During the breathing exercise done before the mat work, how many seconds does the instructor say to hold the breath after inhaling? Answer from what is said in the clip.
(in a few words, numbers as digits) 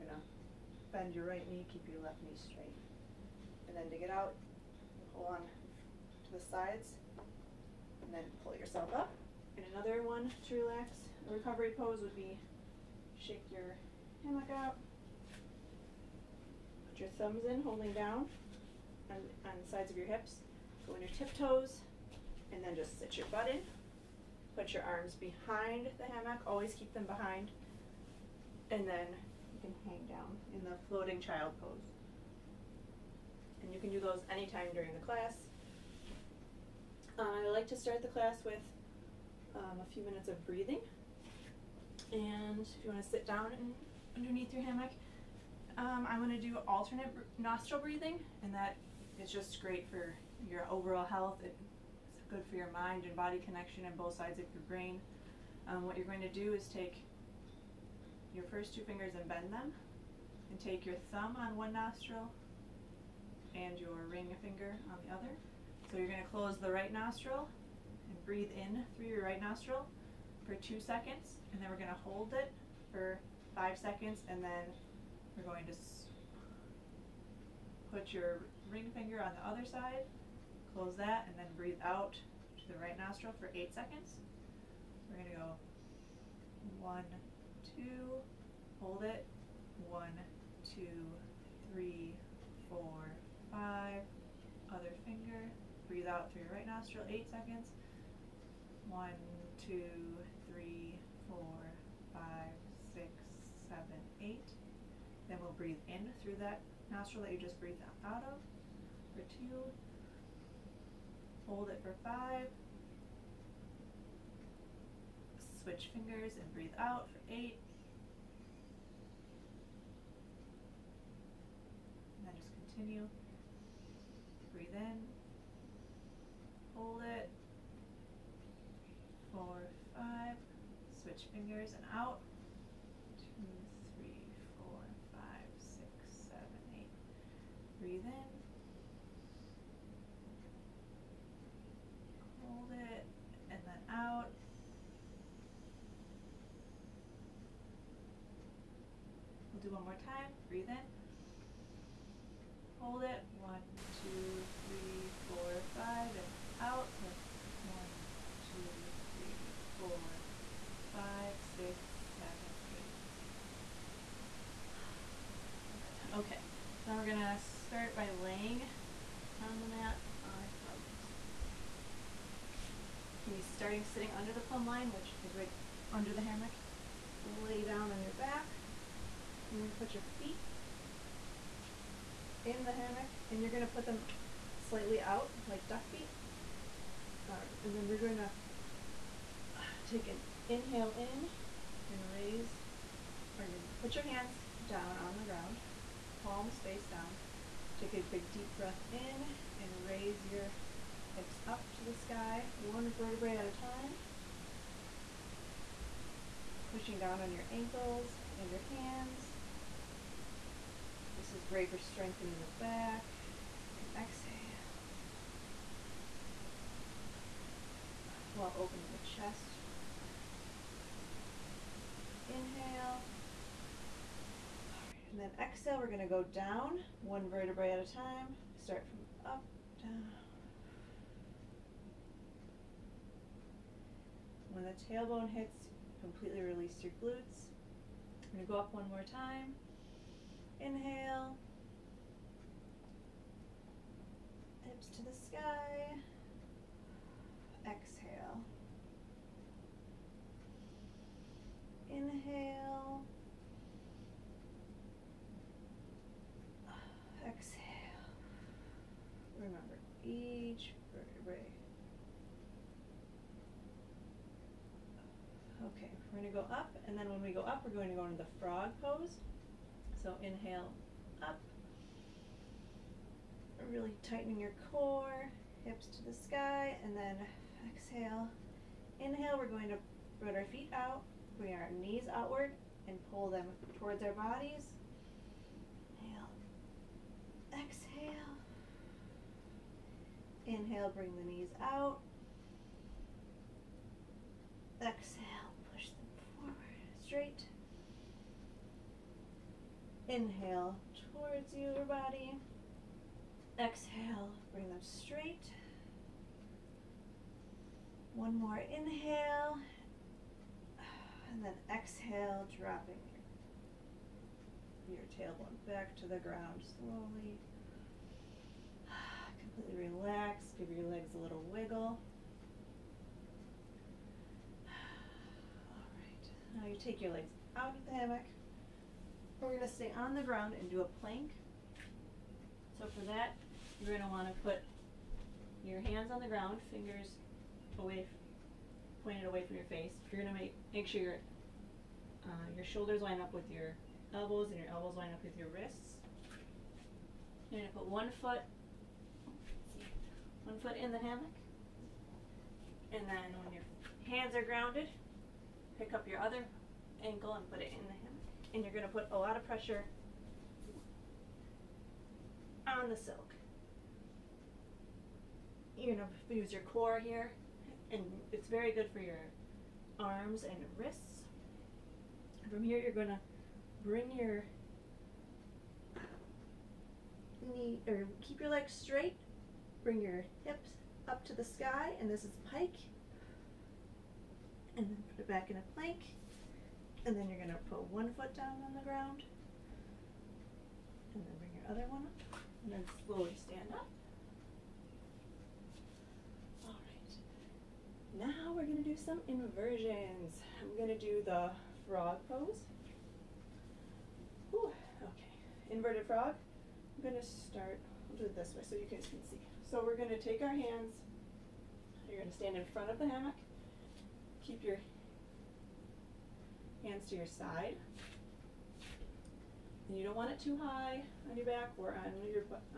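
5.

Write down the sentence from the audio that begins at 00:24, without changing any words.
Put your arms behind the hammock, always keep them behind.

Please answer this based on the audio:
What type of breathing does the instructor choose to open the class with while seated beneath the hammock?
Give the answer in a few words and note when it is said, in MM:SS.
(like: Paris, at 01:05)
alternate nostril breathing, at 00:46.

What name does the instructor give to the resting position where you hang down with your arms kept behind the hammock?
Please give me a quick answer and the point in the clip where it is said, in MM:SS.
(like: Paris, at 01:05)
floating child pose, at 00:30.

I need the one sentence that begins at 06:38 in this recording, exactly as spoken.
Now we're going to do some inversions.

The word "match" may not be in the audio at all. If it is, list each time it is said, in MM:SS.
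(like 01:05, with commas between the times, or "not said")
not said.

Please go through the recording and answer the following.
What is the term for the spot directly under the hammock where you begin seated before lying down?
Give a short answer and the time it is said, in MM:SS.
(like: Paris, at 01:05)
plumb line, at 02:54.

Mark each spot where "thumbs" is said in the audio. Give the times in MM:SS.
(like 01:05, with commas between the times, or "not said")
00:17, 01:01.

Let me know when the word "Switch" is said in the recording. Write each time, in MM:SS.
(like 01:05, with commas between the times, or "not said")
01:55, 02:10.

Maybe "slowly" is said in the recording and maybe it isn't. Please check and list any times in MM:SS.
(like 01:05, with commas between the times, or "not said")
05:16, 06:33.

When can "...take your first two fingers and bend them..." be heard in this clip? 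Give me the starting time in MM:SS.
00:56.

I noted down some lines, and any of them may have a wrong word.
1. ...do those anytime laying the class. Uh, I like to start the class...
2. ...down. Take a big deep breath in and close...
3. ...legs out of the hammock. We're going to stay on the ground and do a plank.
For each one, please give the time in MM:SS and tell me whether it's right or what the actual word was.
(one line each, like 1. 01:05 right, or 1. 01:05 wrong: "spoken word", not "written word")
1. 00:33 wrong: "during", not "laying"
2. 03:16 wrong: "raise", not "close"
3. 05:27 right.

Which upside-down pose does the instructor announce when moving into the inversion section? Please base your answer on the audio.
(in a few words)
inverted frog.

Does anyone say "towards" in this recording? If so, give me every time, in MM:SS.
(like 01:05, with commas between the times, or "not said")
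04:43, 05:01.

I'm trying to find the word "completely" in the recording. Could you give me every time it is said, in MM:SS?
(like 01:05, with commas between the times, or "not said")
03:55, 05:19.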